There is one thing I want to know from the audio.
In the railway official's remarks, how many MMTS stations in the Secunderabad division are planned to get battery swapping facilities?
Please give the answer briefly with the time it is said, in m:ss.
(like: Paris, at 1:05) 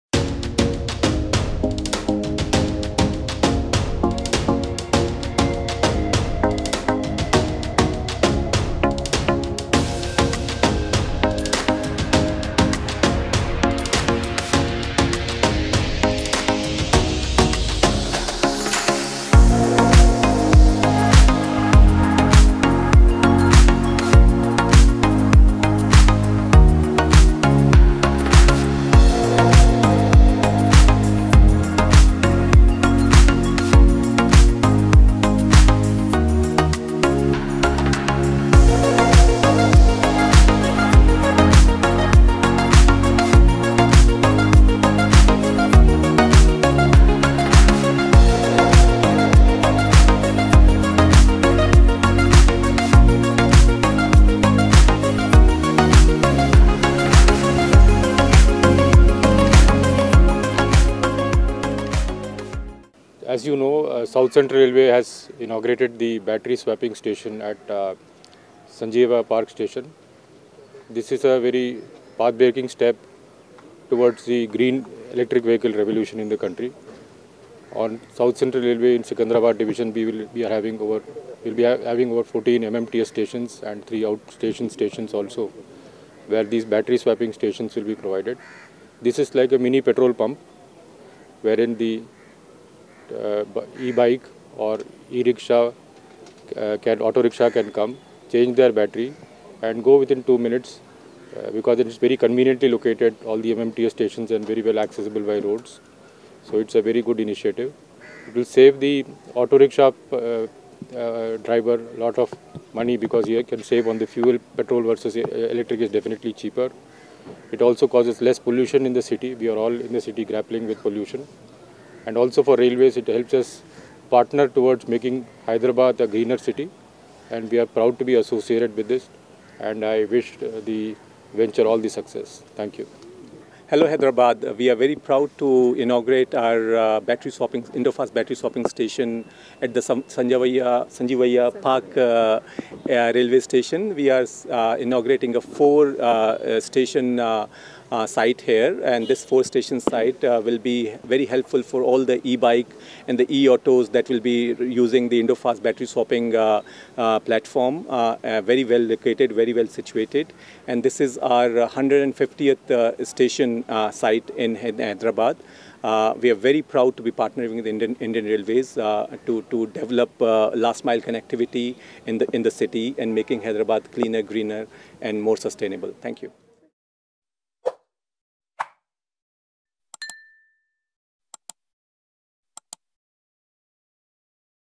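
14, at 1:22.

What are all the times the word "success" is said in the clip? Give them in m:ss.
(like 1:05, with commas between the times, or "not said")
2:11.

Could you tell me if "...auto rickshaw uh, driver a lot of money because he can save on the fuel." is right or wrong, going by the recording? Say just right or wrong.
right.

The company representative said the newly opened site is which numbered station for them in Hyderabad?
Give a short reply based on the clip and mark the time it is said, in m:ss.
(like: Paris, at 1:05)
150th, at 2:41.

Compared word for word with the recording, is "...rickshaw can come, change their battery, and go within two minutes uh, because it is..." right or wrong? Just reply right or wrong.
right.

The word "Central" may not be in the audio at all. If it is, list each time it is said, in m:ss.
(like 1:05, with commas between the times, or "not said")
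1:04, 1:18.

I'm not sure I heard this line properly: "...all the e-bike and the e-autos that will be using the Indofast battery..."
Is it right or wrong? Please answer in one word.
right.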